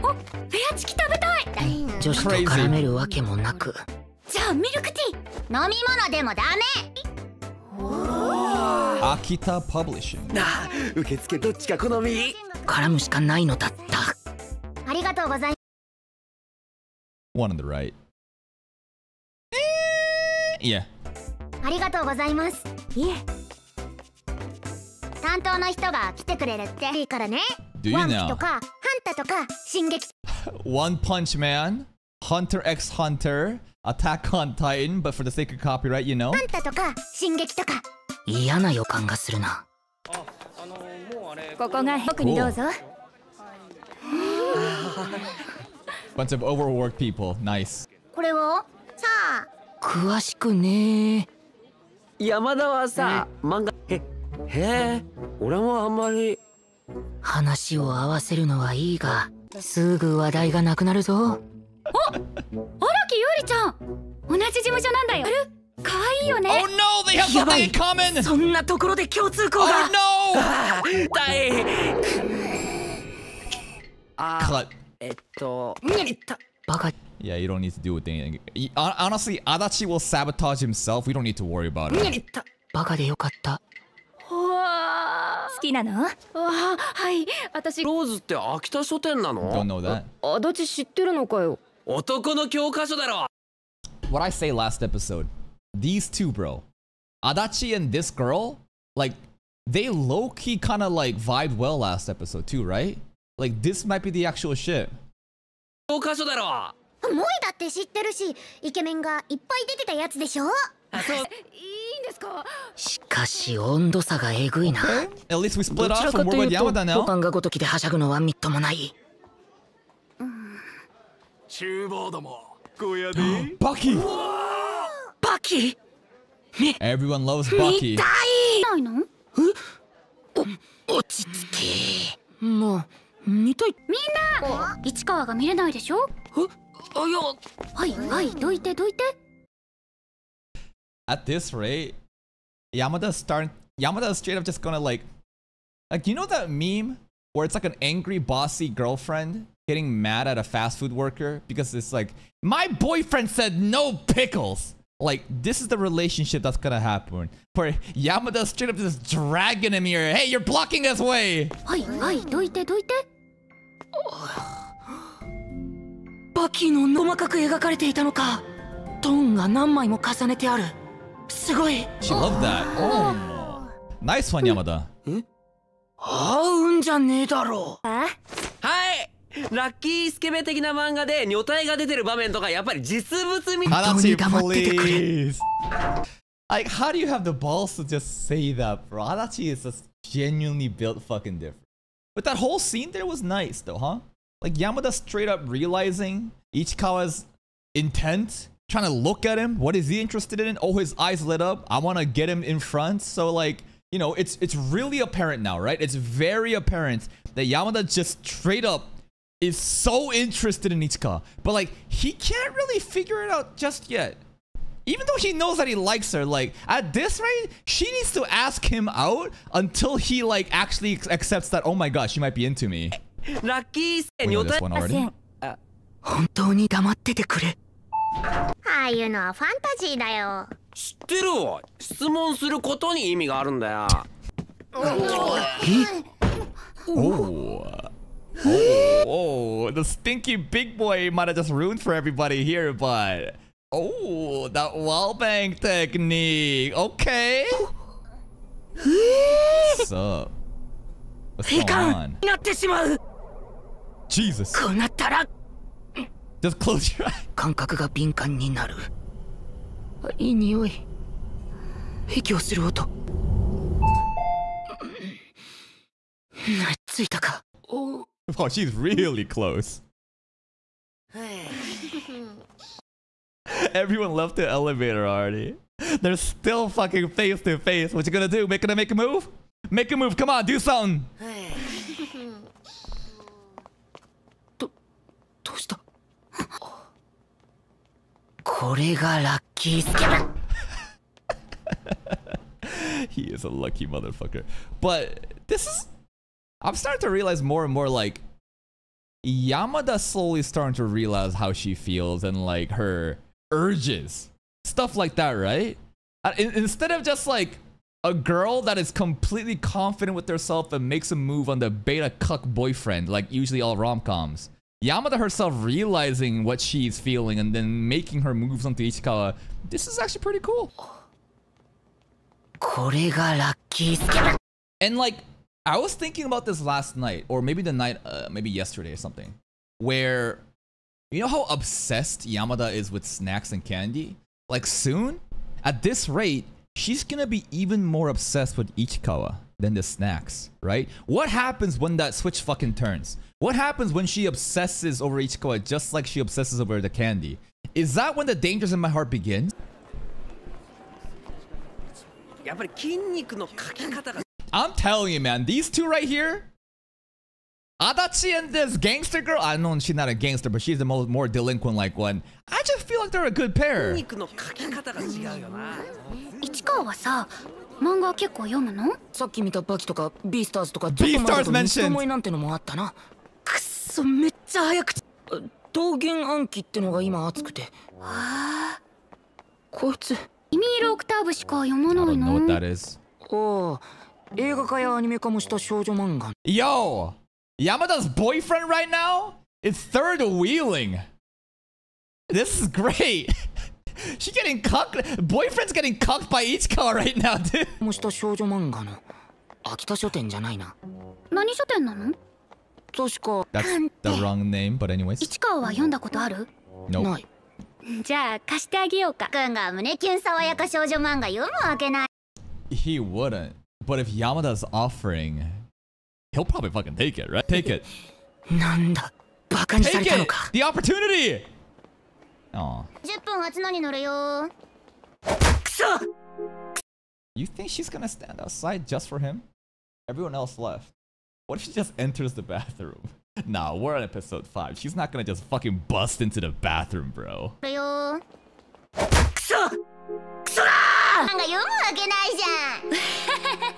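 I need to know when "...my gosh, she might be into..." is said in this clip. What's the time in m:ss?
3:41.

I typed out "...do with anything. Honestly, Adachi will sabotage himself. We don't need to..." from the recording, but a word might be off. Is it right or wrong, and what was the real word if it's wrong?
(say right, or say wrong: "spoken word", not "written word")
right.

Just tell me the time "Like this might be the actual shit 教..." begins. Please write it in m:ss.
1:43.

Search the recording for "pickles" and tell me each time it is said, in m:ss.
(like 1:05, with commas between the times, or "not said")
2:33.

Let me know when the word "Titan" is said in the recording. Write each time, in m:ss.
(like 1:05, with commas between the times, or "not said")
0:34.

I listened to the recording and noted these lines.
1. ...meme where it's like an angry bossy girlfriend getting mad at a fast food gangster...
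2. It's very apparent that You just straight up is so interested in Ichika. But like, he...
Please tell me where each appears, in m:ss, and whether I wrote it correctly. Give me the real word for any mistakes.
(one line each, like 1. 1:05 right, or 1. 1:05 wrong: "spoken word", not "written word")
1. 2:26 wrong: "worker", not "gangster"
2. 3:25 wrong: "Yamada", not "You".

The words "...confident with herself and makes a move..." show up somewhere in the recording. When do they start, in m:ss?
5:09.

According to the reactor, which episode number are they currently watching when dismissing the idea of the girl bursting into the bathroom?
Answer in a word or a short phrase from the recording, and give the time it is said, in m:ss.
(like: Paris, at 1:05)
5, at 7:14.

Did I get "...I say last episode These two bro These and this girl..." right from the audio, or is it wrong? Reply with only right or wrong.
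wrong.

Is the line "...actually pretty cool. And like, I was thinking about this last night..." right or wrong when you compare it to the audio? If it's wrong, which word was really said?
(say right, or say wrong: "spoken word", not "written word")
right.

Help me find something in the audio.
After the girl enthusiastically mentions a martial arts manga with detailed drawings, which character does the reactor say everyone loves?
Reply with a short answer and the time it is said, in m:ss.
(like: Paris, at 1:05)
Bucky, at 2:07.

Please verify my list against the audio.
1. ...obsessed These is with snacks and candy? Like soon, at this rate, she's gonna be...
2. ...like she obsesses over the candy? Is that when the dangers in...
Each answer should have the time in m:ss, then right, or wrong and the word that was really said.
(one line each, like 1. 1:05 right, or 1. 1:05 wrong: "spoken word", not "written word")
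1. 5:31 wrong: "Yamada", not "These"
2. 5:45 right.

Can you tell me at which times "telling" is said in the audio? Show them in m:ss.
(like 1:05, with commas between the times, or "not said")
5:54.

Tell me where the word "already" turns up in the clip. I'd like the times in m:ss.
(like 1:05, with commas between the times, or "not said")
3:44, 4:35.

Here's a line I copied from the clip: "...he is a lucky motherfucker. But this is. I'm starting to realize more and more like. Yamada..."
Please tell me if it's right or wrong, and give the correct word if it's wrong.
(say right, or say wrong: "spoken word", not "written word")
right.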